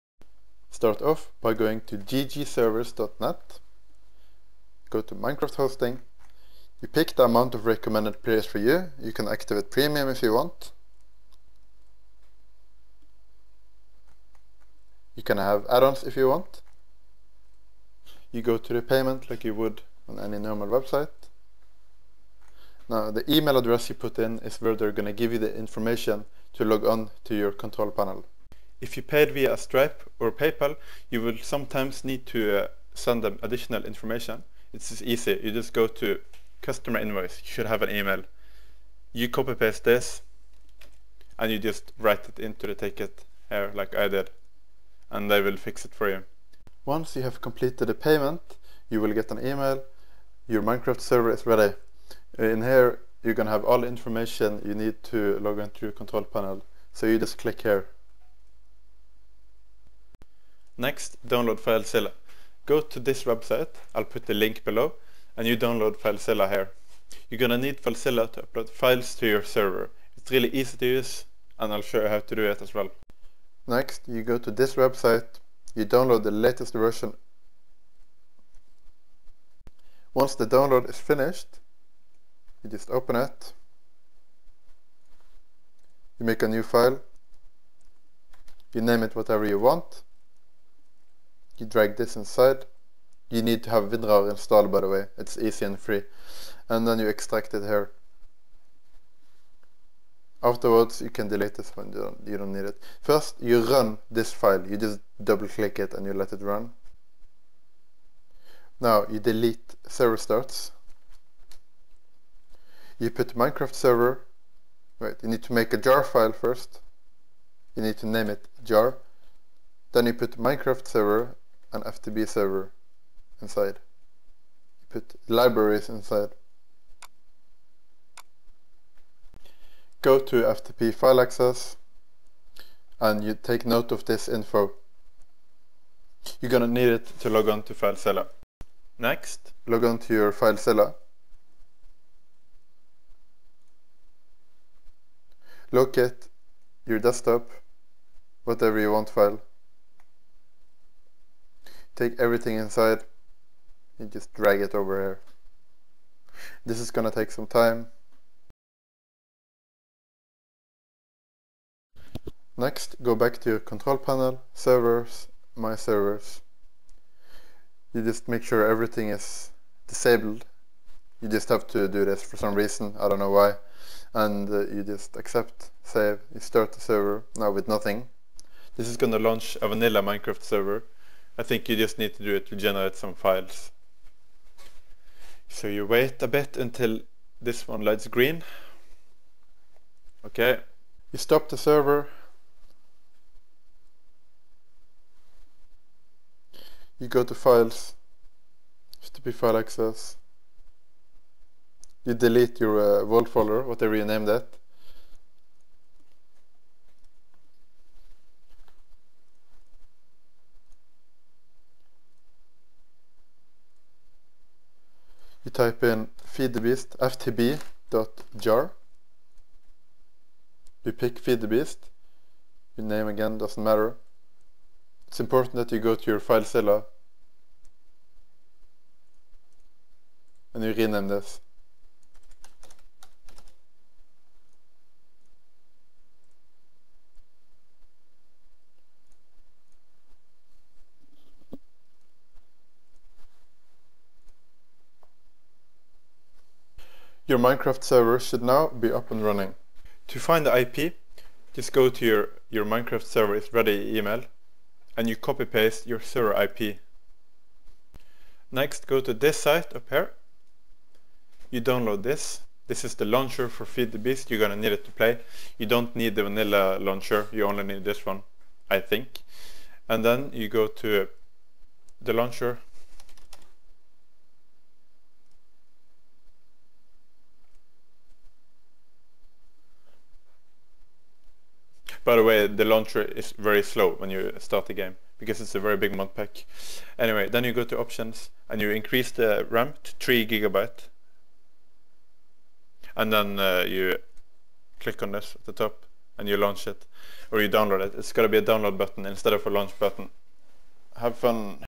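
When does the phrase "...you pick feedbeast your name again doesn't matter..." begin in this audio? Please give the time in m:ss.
3:40.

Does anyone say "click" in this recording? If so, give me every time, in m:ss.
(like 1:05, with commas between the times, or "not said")
0:57, 1:45, 4:54.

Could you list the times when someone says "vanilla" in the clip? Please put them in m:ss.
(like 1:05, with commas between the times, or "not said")
2:59, 4:26.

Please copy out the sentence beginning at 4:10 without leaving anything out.
To find the IP, just go to your, your Minecraft server is ready email and you copy paste your server IP.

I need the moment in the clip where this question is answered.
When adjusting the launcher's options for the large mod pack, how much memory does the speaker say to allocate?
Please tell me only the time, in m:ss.
4:49.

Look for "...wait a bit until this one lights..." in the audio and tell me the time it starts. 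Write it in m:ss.
3:05.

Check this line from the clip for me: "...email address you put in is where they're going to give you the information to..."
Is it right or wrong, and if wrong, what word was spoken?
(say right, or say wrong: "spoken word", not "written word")
right.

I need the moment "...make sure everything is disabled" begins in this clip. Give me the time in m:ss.
2:48.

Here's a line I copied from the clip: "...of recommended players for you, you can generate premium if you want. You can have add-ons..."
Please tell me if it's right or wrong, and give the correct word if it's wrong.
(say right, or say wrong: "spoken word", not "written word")
wrong: "activate", not "generate".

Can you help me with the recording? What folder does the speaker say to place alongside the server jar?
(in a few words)
libraries.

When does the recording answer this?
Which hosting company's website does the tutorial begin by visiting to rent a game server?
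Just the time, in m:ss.
0:01.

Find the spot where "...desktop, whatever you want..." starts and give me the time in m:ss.
2:26.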